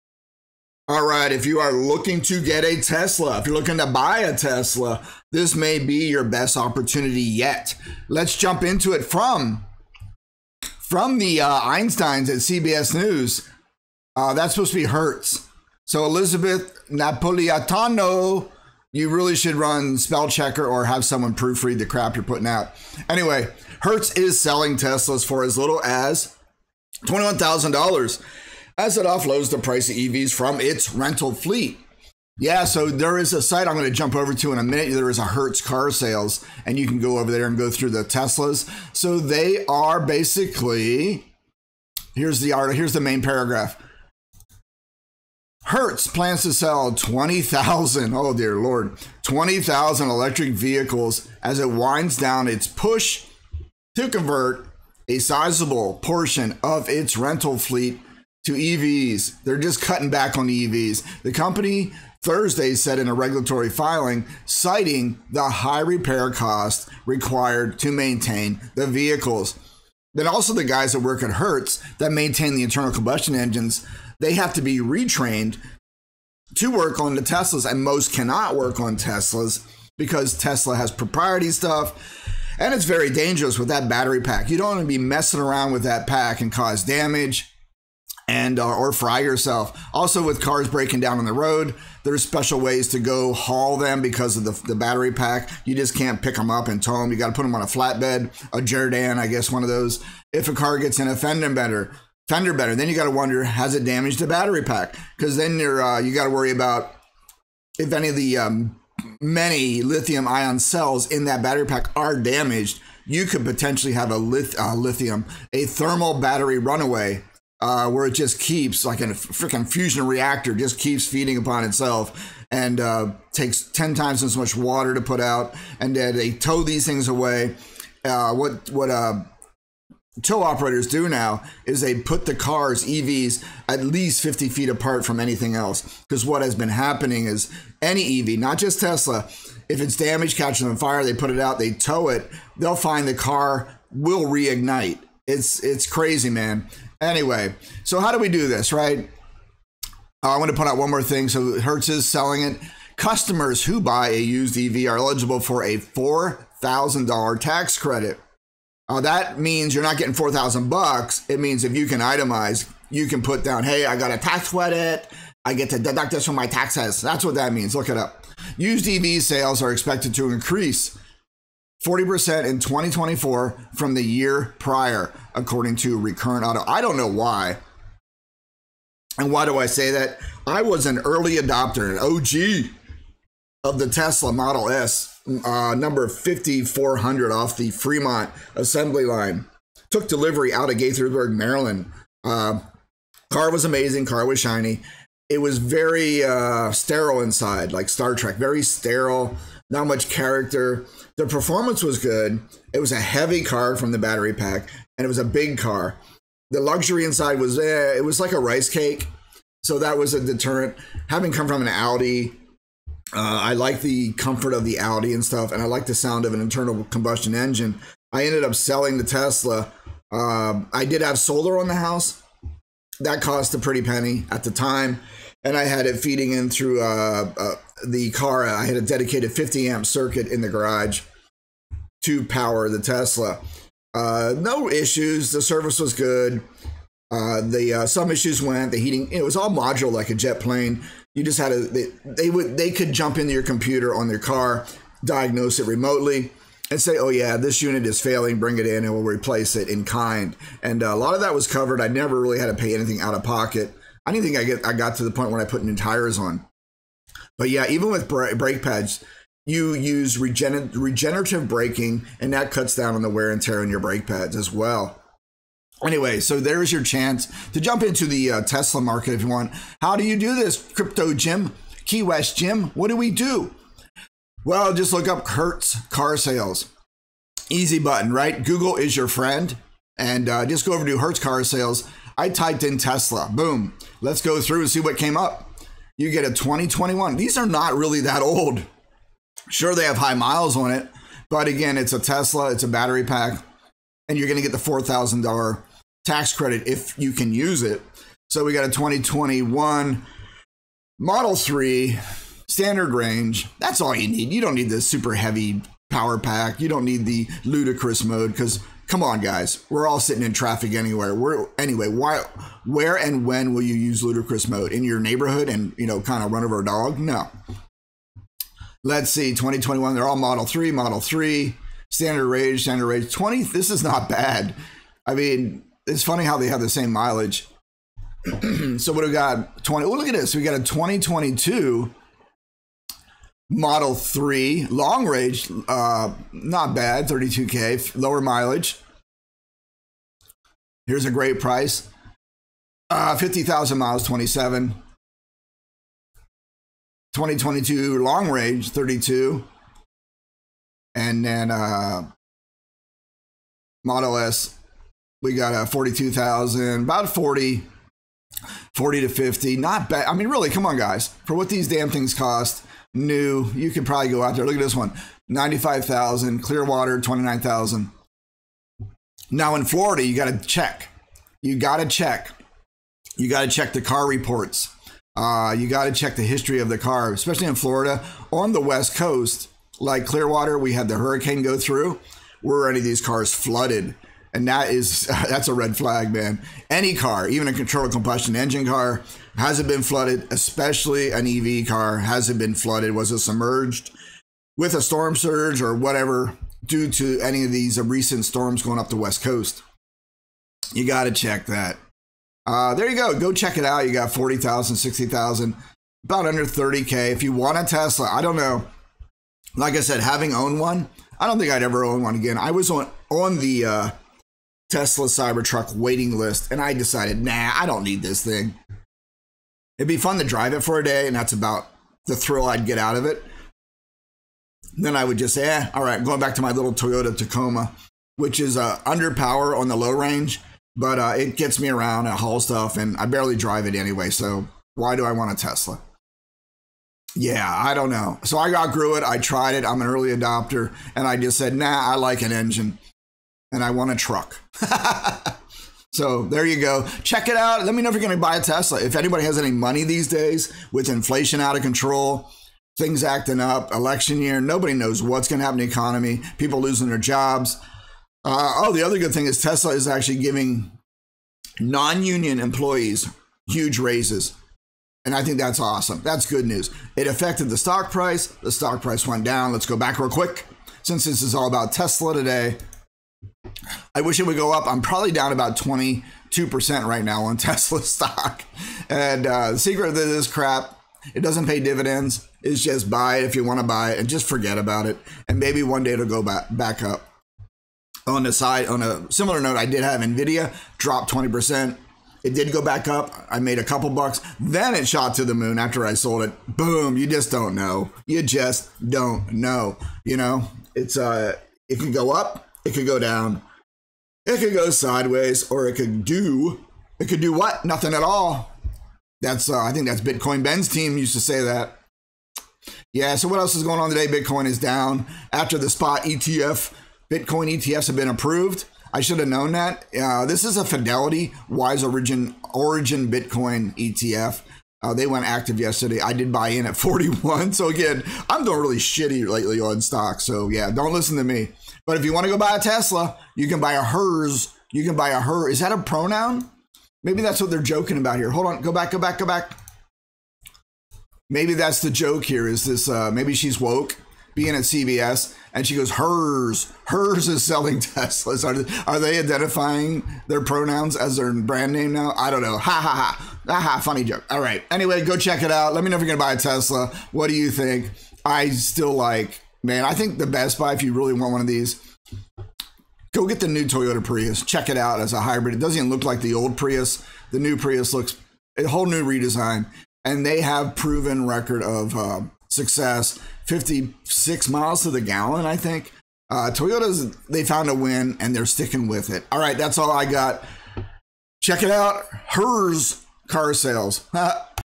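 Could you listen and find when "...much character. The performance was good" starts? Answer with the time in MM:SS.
03:19.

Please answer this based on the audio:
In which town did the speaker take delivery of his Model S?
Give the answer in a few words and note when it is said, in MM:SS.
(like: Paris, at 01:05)
Gaithersburg, Maryland, at 03:10.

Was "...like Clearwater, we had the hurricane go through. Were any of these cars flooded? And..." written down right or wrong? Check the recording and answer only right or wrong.
right.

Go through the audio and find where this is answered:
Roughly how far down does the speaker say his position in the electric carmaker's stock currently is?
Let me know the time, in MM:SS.
07:55.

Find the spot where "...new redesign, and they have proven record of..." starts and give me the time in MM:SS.
09:28.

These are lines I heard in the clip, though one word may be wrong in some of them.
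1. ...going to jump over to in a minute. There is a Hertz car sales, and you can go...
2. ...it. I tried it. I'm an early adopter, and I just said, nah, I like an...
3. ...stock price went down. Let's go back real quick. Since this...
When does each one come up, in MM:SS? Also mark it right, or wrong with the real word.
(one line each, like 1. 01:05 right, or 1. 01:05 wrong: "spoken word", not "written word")
1. 00:33 right
2. 07:18 right
3. 07:48 right.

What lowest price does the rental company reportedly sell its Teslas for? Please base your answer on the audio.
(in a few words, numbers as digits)
$21,000.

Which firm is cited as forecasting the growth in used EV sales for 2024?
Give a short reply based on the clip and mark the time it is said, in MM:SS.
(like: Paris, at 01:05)
Recurrent Auto, at 02:55.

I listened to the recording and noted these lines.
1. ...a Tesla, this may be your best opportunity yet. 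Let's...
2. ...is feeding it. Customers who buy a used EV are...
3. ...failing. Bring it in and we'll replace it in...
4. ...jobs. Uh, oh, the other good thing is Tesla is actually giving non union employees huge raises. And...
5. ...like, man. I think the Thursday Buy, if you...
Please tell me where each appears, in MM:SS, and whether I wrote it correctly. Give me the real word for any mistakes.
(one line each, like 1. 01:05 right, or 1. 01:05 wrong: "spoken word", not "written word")
1. 00:04 right
2. 02:31 wrong: "selling", not "feeding"
3. 04:07 right
4. 07:36 right
5. 09:18 wrong: "Best", not "Thursday".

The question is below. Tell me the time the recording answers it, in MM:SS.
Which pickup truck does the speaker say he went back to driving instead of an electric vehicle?
07:06.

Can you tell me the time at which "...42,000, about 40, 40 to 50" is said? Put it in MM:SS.
05:55.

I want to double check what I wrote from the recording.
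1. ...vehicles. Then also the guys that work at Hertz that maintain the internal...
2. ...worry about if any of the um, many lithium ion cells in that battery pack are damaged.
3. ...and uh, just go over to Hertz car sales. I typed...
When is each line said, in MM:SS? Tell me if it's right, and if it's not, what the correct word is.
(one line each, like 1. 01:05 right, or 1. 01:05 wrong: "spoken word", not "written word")
1. 01:08 right
2. 01:46 right
3. 04:39 right.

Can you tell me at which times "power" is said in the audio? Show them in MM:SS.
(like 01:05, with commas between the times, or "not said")
03:52, 05:05, 07:09.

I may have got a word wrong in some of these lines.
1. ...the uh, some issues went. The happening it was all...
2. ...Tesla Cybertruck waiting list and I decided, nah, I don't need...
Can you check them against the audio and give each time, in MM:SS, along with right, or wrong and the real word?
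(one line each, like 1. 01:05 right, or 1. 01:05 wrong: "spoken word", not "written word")
1. 03:57 wrong: "heating", not "happening"
2. 06:54 right.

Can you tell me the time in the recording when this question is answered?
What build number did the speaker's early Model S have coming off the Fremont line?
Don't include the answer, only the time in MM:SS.
03:06.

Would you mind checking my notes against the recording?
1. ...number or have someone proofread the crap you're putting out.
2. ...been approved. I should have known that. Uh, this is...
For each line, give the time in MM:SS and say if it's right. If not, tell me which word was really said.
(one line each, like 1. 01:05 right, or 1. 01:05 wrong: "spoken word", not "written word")
1. 00:20 wrong: "checker", not "number"
2. 08:37 right.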